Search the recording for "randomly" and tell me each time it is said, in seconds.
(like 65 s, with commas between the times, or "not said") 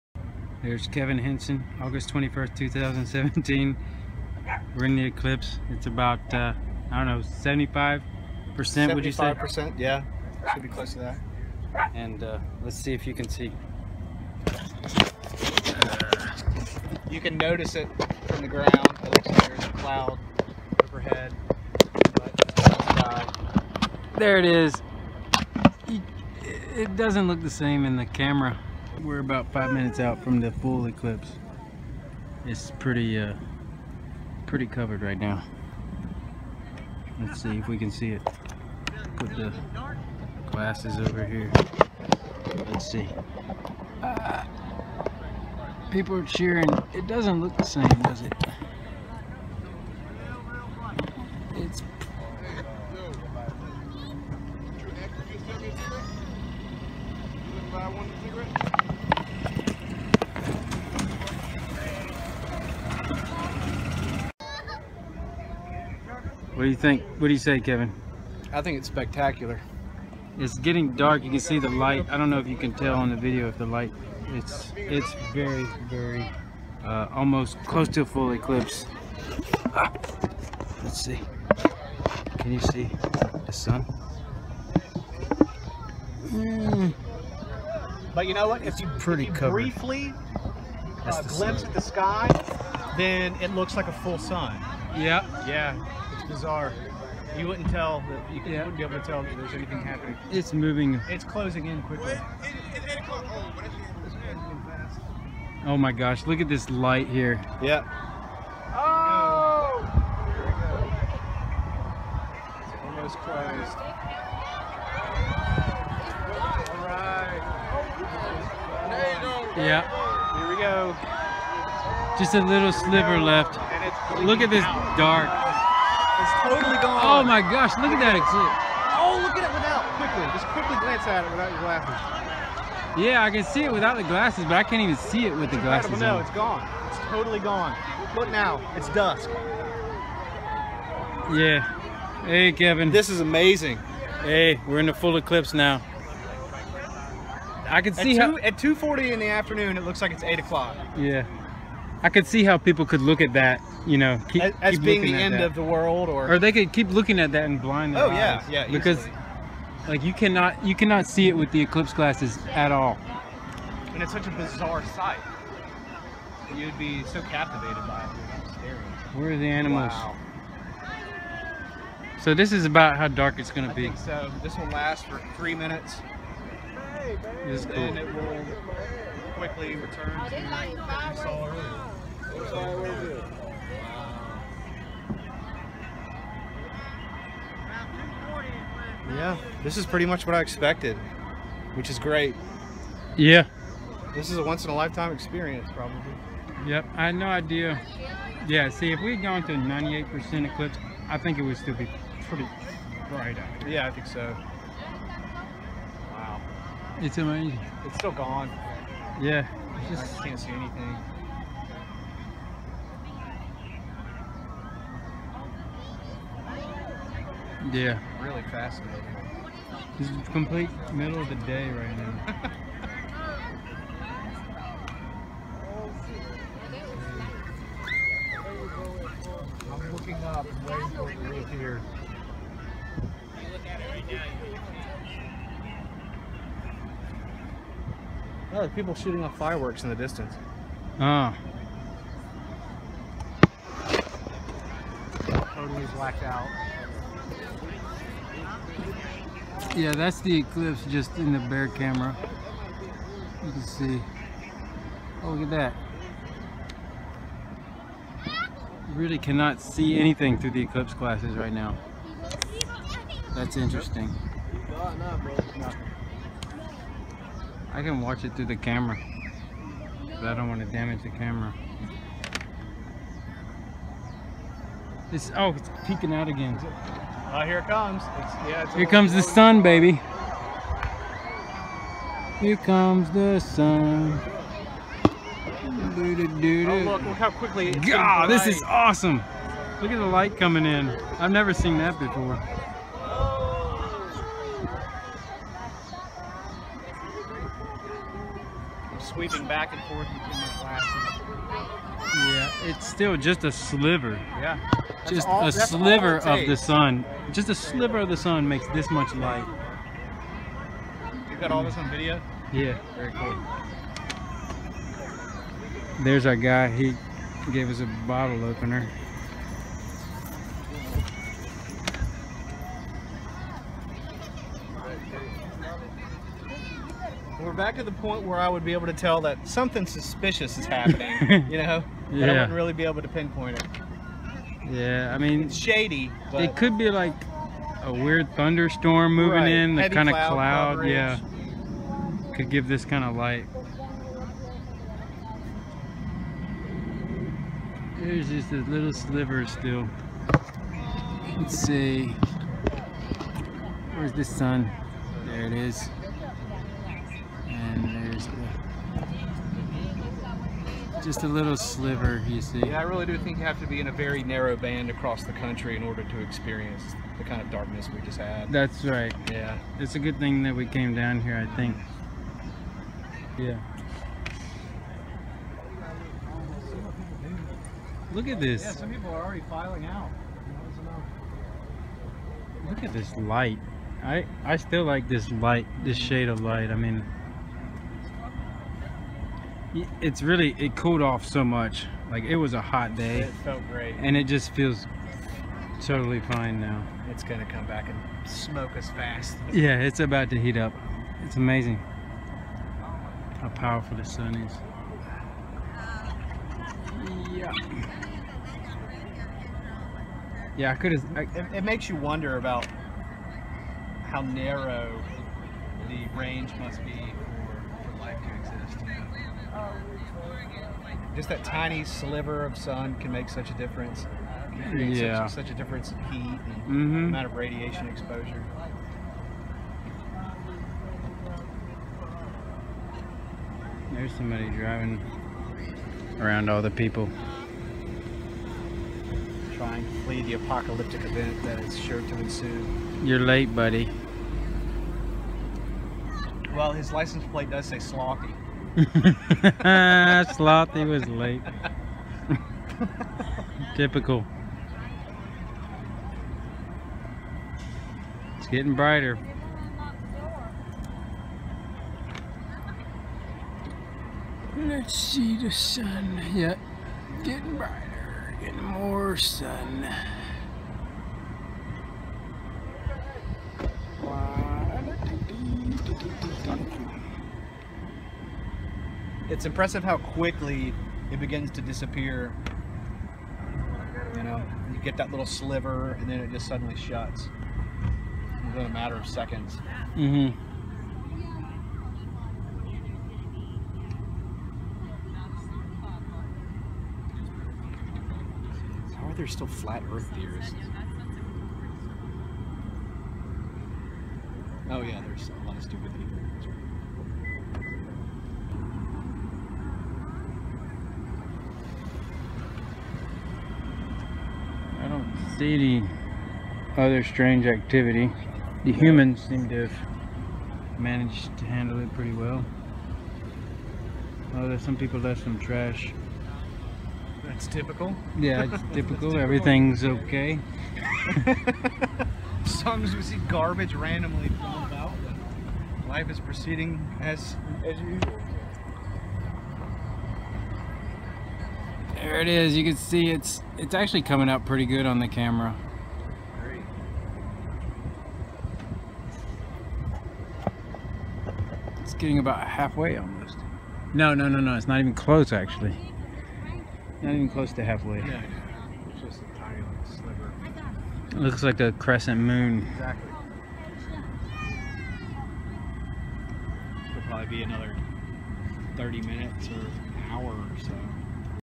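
533 s.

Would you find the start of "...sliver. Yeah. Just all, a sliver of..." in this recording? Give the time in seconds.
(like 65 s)
303 s.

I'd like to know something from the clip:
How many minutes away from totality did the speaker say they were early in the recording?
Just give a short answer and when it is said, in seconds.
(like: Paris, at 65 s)
5, at 29 s.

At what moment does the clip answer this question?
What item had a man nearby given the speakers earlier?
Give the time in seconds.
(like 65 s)
318 s.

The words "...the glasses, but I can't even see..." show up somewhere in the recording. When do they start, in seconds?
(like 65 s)
133 s.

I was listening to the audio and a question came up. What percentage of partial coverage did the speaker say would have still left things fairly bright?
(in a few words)
98%.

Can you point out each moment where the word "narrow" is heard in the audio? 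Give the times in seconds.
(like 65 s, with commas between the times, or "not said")
364 s, 414 s.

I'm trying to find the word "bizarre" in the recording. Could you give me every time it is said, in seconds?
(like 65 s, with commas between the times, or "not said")
96 s, 164 s.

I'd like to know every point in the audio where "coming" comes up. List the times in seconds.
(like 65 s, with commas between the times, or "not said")
290 s, 544 s.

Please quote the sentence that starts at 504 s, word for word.
Oh yeah, there's a lot of stupid people.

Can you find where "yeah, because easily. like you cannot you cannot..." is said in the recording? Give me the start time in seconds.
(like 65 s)
158 s.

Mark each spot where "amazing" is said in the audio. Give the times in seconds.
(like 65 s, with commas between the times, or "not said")
143 s, 207 s, 401 s.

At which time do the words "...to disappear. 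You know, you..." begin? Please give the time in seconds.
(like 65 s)
481 s.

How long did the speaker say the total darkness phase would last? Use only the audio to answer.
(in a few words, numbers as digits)
3 minutes.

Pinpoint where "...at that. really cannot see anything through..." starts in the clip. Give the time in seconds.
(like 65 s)
255 s.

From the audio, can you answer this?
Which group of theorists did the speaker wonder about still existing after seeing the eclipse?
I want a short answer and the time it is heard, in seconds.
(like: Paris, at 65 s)
Flat earth theorists, at 499 s.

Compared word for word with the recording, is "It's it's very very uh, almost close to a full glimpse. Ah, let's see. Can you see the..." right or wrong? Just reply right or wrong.
wrong.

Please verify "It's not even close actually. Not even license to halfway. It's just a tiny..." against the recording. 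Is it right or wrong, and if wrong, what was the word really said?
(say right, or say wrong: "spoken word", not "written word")
wrong: "close", not "license".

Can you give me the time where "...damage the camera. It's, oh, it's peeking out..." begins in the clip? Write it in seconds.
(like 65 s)
270 s.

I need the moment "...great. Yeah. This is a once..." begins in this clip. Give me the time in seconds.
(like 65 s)
191 s.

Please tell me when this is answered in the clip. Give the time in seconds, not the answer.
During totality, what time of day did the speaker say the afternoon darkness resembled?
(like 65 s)
150 s.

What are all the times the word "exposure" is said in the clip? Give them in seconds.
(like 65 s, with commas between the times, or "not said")
427 s.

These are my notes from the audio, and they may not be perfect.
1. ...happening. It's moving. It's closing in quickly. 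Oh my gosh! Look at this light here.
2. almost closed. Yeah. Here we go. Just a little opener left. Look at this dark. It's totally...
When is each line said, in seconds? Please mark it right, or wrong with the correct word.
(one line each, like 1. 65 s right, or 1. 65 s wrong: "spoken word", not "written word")
1. 99 s right
2. 112 s wrong: "sliver", not "opener".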